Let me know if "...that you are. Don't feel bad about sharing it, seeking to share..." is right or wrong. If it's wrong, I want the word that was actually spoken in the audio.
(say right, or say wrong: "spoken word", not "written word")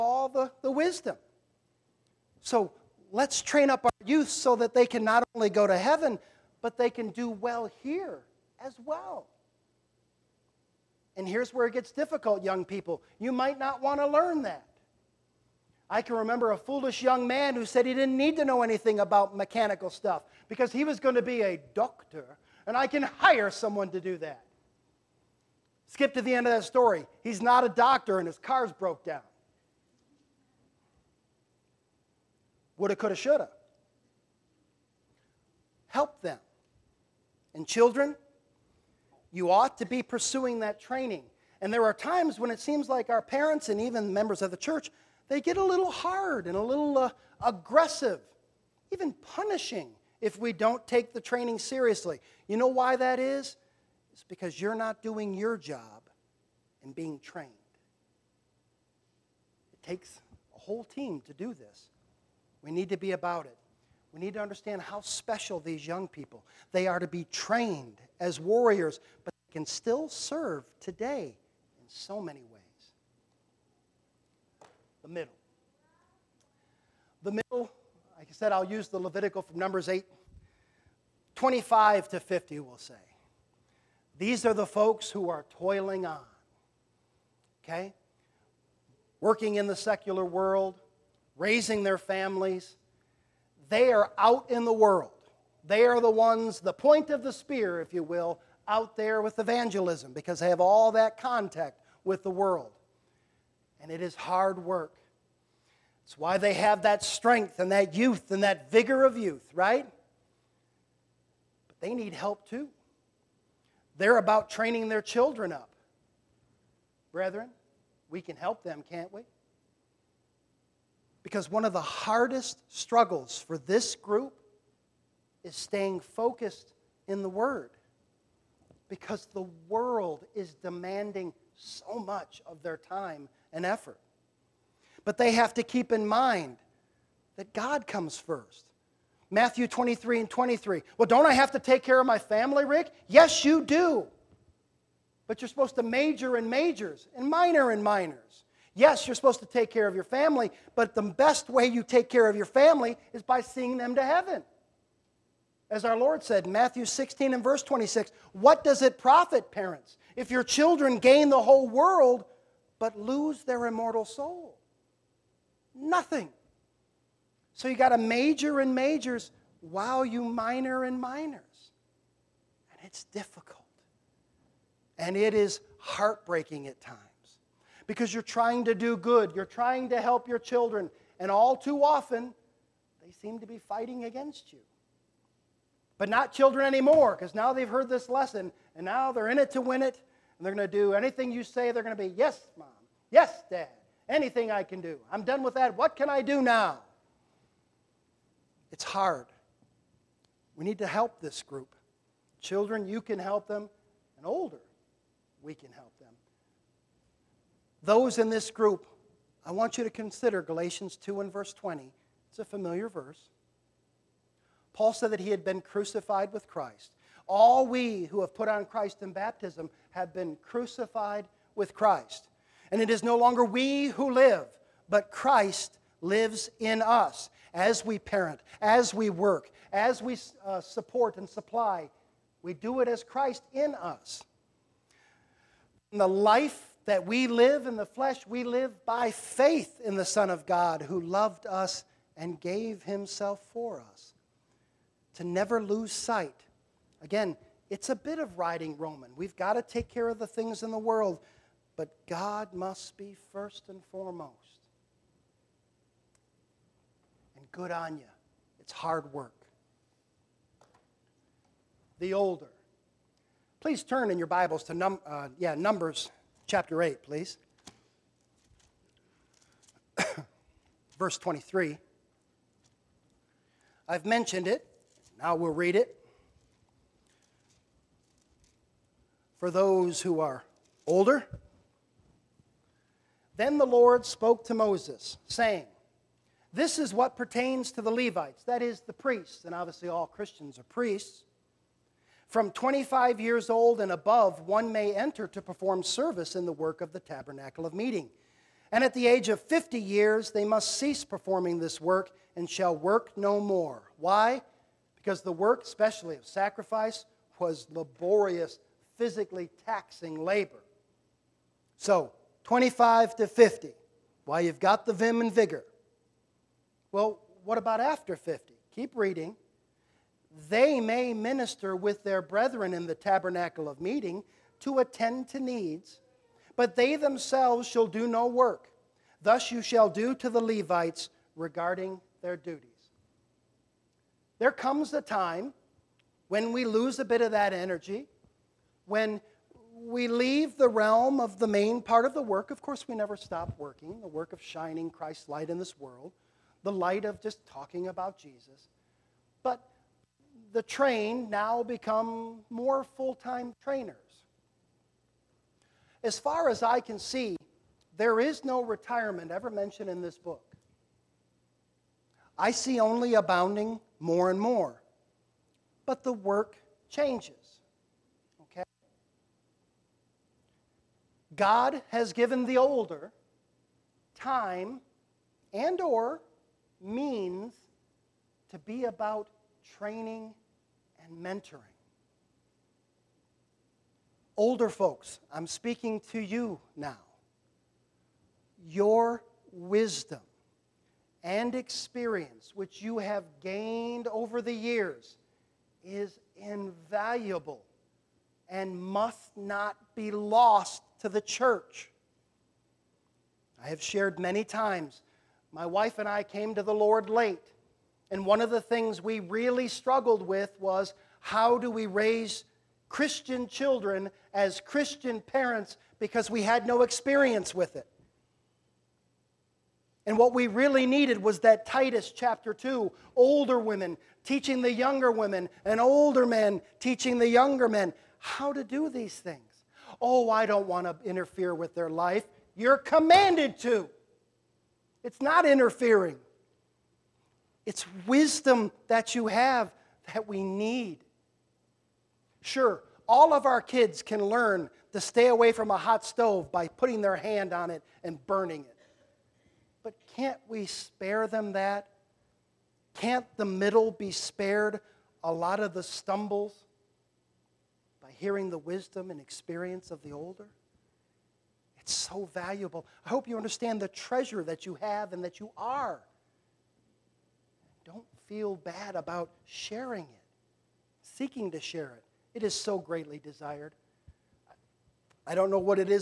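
right.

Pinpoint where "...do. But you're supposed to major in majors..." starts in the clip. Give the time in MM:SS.
02:23.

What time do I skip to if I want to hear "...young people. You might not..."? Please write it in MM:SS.
00:12.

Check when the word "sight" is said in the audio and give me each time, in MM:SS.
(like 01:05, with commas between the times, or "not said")
04:05.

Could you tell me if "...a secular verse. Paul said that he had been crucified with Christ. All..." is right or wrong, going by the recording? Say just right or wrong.
wrong.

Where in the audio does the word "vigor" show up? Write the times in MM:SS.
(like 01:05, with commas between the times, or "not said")
01:48, 05:15.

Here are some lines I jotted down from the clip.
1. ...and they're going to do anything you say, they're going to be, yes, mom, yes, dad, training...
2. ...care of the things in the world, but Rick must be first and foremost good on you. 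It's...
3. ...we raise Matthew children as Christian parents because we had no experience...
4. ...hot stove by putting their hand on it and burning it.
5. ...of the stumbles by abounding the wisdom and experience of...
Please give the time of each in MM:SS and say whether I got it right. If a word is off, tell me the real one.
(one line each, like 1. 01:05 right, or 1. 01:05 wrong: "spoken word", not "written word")
1. 03:10 wrong: "anything", not "training"
2. 04:09 wrong: "God", not "Rick"
3. 06:51 wrong: "Christian", not "Matthew"
4. 07:25 right
5. 07:35 wrong: "hearing", not "abounding".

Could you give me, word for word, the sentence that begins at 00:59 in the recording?
It takes a whole team to do this.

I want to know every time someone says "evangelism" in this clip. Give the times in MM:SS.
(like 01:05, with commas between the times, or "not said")
01:39.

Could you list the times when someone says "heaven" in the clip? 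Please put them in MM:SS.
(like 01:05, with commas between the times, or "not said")
00:05, 02:34.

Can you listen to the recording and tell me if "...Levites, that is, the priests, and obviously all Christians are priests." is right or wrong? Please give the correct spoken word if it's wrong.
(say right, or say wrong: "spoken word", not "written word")
right.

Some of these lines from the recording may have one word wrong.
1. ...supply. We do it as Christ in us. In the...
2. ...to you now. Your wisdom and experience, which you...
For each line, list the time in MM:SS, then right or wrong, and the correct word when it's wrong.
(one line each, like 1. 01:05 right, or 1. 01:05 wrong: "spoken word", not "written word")
1. 03:51 right
2. 06:26 right.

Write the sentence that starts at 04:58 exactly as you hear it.
And at the age of 50 years, they must cease performing this work and shall work no more.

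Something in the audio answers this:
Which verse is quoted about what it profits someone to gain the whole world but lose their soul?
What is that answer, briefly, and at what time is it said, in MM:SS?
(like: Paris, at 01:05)
Matthew 16:26, at 02:36.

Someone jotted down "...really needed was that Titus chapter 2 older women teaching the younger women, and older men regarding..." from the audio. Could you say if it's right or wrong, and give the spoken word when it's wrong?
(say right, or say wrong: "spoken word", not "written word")
wrong: "teaching", not "regarding".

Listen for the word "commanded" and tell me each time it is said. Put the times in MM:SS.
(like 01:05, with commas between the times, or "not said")
07:12.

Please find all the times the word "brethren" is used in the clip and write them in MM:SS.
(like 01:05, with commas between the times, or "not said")
01:57, 05:22.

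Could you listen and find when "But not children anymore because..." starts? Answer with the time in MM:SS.
03:05.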